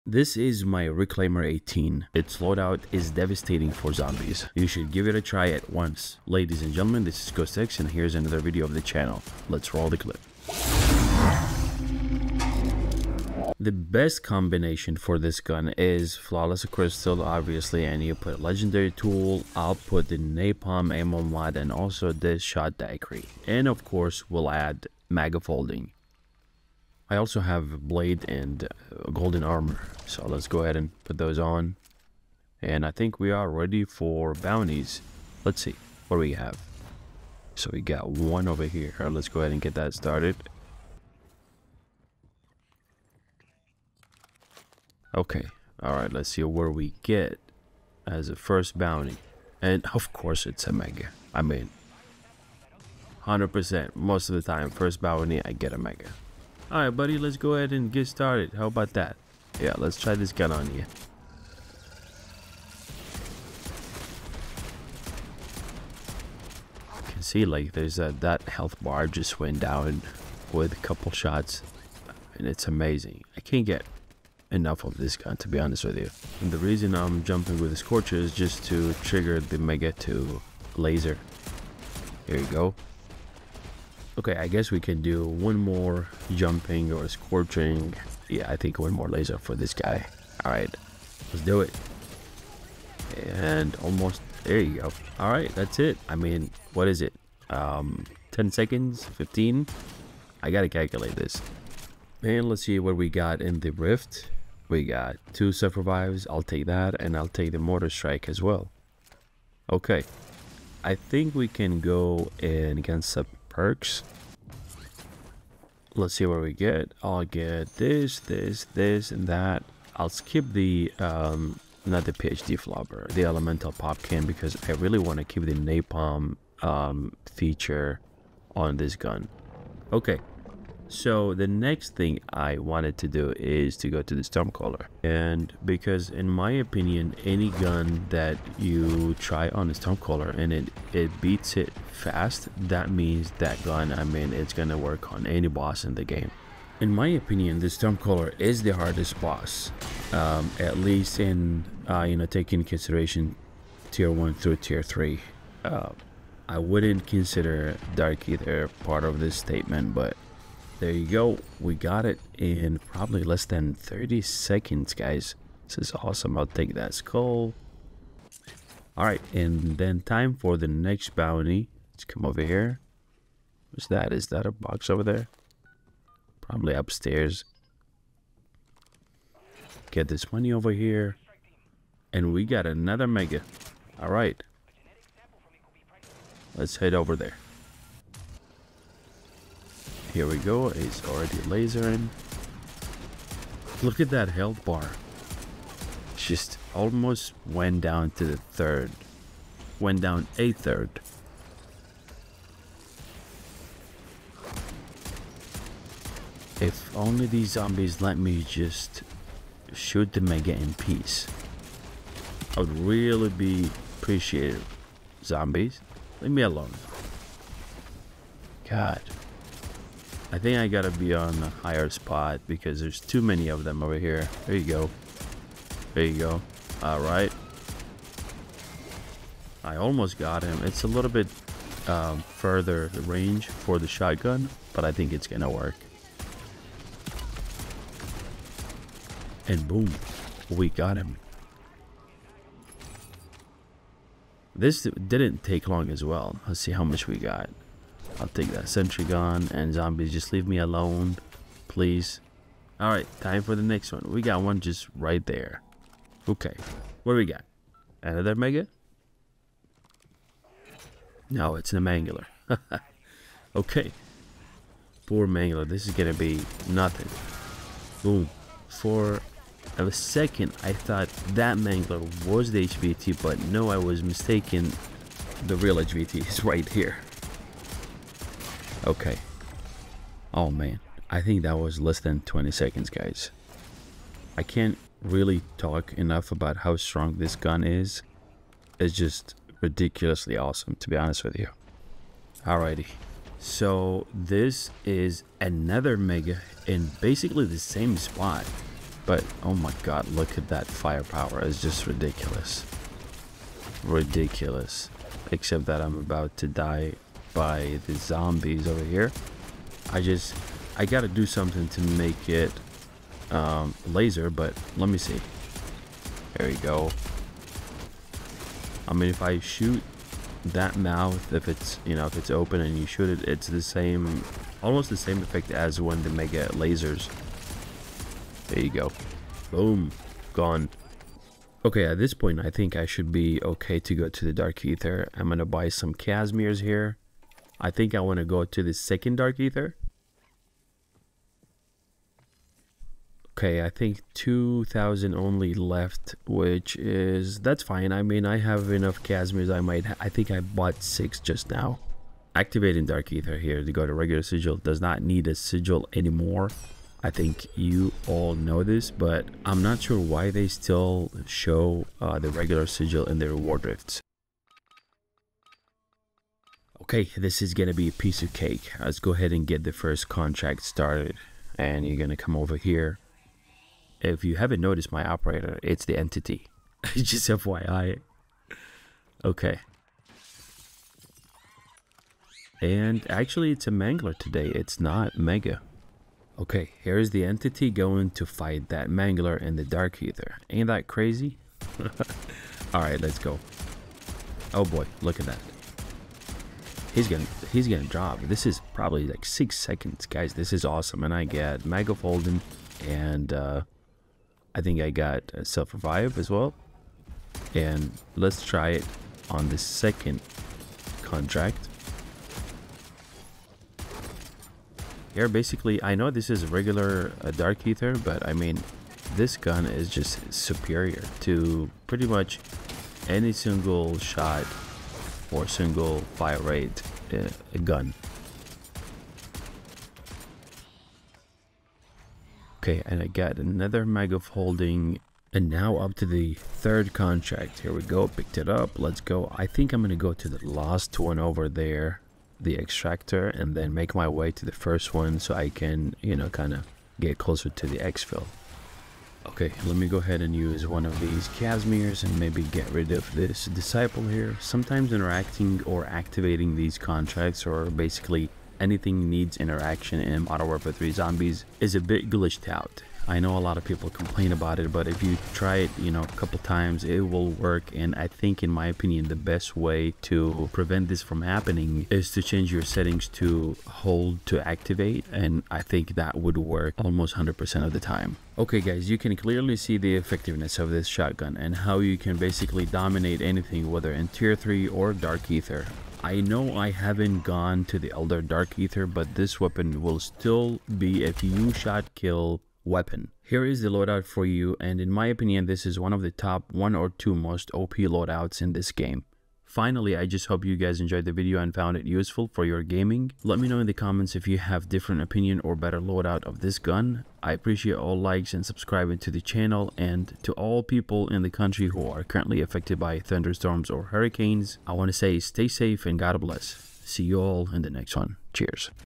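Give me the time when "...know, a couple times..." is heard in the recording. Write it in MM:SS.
07:45.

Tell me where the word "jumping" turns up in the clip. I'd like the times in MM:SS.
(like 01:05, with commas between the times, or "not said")
01:17, 01:26.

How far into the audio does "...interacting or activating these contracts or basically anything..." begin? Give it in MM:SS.
07:34.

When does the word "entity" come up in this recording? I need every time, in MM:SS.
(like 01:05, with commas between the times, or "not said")
06:15, 06:27.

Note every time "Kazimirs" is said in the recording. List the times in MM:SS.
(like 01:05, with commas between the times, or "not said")
05:35, 05:49, 07:31.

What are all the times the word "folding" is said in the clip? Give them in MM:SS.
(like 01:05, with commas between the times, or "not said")
00:25.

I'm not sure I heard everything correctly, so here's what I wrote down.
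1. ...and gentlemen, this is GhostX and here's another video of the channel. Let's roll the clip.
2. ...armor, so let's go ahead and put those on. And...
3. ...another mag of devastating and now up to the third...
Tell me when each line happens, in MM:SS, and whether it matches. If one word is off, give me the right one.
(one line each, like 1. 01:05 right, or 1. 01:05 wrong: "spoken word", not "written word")
1. 00:06 right
2. 00:29 right
3. 07:13 wrong: "holding", not "devastating".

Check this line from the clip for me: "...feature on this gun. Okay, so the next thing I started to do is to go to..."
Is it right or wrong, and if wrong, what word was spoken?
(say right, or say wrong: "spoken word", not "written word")
wrong: "wanted", not "started".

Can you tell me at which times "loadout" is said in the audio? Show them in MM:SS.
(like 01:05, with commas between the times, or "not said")
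00:02, 08:13, 08:17, 08:25.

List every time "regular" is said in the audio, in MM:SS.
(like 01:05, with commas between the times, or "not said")
05:53, 06:02, 06:56.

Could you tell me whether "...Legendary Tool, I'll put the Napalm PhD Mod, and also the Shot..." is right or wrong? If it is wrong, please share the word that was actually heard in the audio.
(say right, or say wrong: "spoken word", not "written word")
wrong: "Ammo", not "PhD".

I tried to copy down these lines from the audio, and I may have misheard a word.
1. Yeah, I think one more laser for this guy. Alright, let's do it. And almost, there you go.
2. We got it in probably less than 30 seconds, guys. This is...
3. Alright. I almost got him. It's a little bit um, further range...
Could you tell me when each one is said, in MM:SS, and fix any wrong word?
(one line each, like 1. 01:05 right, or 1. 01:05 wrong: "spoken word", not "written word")
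1. 01:28 right
2. 02:41 right
3. 03:46 right.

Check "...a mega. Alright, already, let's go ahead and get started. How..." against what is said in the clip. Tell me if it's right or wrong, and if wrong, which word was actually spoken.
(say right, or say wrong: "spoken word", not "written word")
wrong: "buddy", not "already".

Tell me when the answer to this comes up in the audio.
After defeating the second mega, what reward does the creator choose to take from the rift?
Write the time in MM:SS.
04:08.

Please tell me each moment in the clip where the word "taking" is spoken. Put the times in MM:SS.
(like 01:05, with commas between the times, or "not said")
02:32.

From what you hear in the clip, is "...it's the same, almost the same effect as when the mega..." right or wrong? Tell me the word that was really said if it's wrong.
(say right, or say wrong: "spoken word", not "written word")
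right.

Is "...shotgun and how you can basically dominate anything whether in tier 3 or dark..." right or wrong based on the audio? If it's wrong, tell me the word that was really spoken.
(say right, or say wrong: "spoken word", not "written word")
right.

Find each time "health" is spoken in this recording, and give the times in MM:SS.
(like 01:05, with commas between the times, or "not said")
01:08, 03:14.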